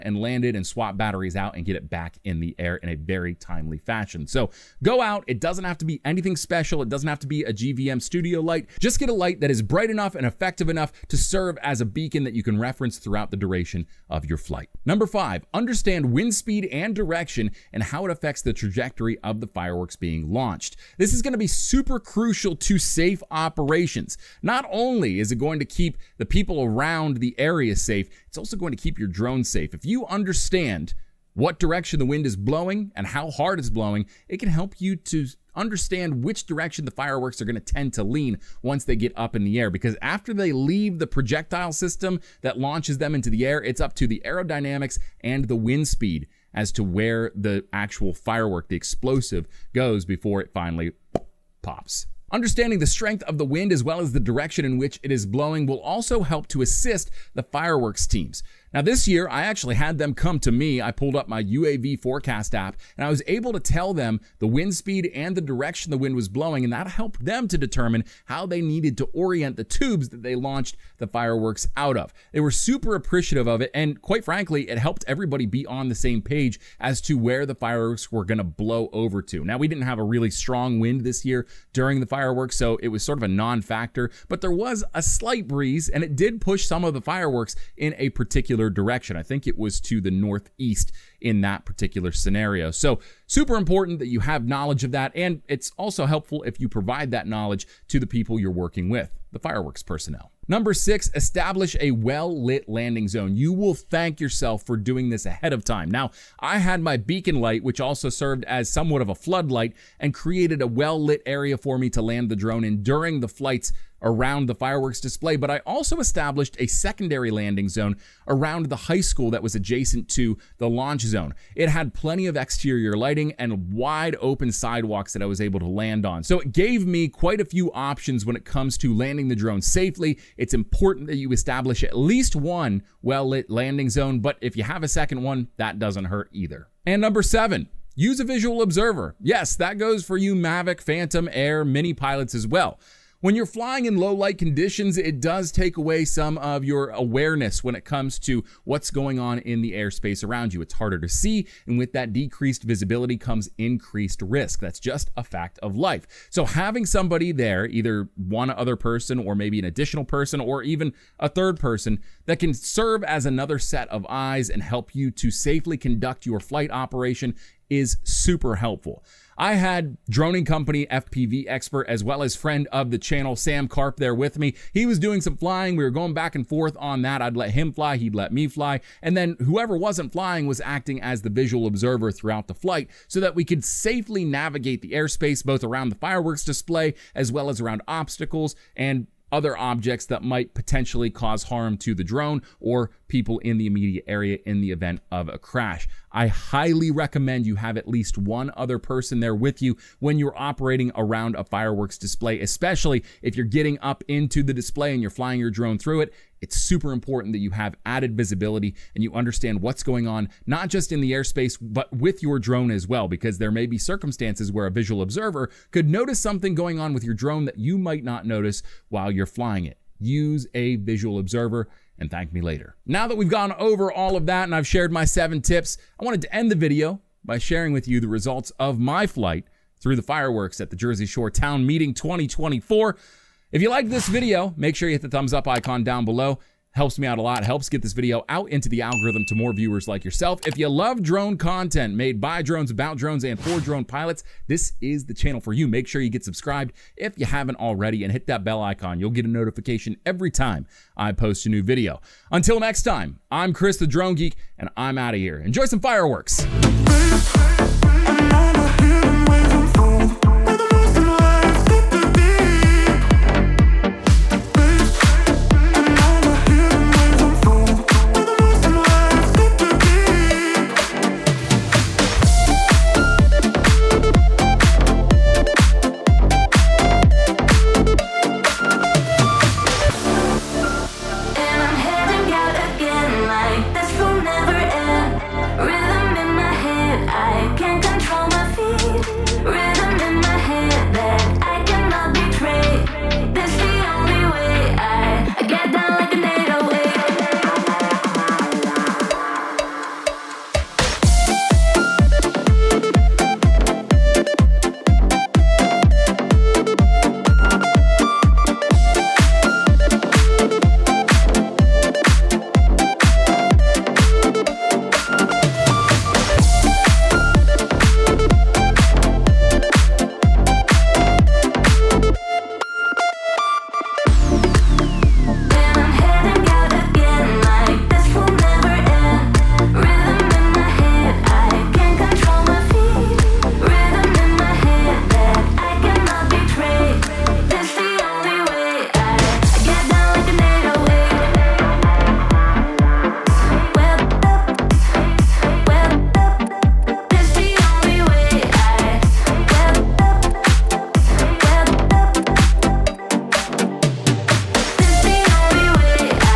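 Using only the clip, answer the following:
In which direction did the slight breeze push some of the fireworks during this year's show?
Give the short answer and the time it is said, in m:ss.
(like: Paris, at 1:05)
Northeast, at 1:30.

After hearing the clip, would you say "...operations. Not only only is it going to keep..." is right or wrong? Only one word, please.
right.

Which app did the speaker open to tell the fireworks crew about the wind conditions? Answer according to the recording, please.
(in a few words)
UAV Forecast.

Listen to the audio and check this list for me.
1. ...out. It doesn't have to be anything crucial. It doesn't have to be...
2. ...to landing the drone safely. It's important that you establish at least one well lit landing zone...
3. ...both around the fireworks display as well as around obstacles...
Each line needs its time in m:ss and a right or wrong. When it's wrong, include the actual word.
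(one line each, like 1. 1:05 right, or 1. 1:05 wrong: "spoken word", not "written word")
1. 0:05 wrong: "special", not "crucial"
2. 2:08 right
3. 3:05 right.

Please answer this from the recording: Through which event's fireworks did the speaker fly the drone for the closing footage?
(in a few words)
Jersey Shore Town Meeting 2024.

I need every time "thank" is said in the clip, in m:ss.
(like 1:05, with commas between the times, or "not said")
1:43, 3:42.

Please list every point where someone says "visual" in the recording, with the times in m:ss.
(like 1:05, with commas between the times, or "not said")
2:18, 3:01, 3:34, 3:40.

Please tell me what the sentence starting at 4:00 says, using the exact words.
If you love drone content made by drones, about drones, and for drone pilots, this is the channel for you.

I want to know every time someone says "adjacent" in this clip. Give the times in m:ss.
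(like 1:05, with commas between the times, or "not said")
1:59.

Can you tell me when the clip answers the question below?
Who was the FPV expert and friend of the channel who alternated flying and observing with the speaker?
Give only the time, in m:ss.
2:53.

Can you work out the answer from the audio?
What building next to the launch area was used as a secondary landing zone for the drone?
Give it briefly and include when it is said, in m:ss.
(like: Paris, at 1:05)
High school, at 1:58.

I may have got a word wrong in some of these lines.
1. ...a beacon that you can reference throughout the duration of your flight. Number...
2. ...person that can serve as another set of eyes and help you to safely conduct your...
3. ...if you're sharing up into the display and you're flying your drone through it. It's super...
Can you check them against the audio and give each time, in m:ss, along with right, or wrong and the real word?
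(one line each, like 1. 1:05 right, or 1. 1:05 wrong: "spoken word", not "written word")
1. 0:11 right
2. 2:41 right
3. 3:23 wrong: "getting", not "sharing".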